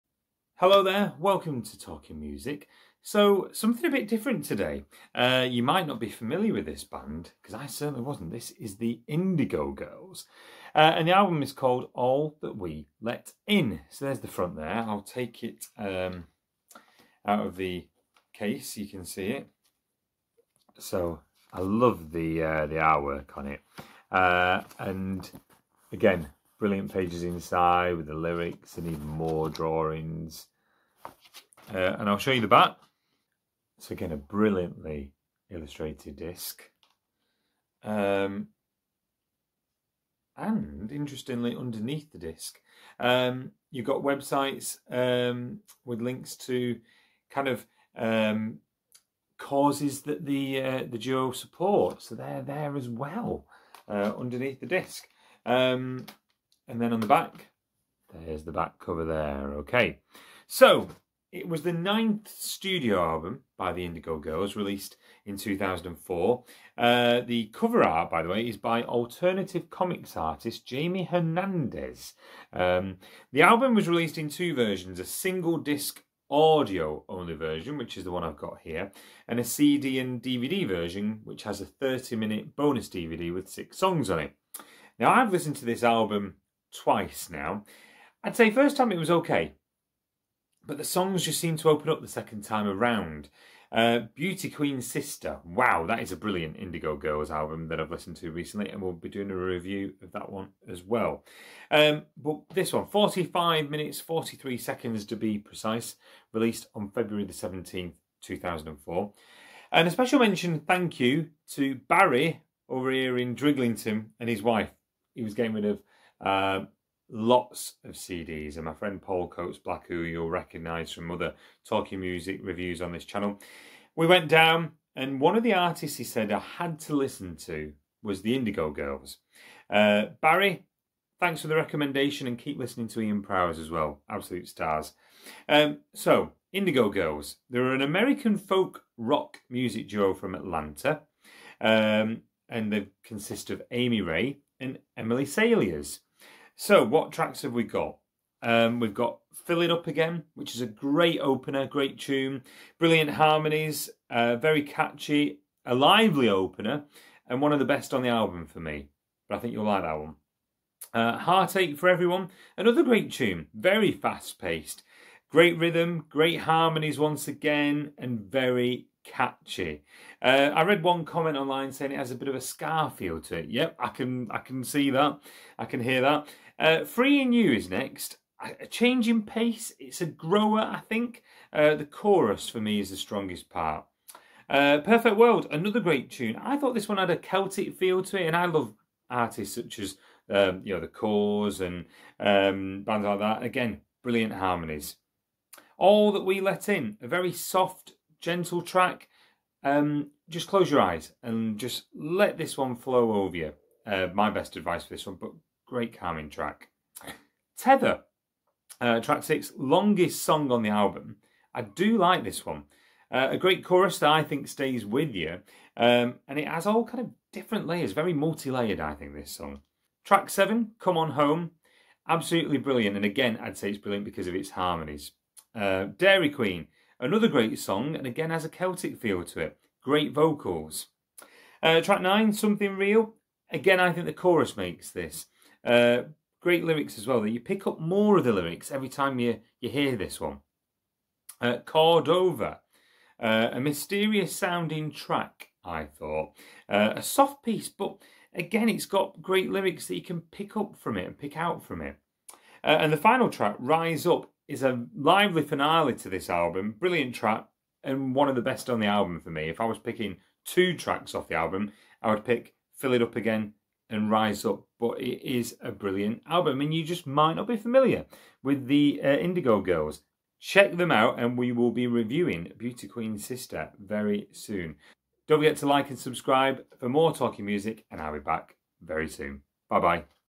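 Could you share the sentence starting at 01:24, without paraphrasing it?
Now, I've listened to this album twice now.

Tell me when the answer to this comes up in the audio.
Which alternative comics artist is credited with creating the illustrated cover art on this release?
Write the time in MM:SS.
01:10.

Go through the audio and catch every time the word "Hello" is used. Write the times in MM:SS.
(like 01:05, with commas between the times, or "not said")
00:00.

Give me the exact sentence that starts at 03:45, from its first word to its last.
Uh, Dairy Queen, Another great song, and again has a Celtic feel to it.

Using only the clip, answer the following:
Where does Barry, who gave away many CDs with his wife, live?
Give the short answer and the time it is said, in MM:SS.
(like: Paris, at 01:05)
Drighlington, at 01:53.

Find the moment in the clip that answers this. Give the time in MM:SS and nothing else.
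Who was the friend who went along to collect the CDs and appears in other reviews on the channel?
01:59.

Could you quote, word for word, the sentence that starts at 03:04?
Uh, Perfect World, another great tune.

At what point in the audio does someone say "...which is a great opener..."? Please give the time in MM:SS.
02:30.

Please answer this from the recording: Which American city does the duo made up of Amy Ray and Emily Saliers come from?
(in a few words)
Atlanta.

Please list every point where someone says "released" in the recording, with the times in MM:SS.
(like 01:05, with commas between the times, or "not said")
01:04, 01:13, 01:46.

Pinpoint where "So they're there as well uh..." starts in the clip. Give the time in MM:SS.
00:52.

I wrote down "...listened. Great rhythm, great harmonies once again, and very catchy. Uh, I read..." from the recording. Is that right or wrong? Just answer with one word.
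wrong.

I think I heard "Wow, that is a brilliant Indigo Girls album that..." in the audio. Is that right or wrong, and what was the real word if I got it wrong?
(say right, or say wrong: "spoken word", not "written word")
right.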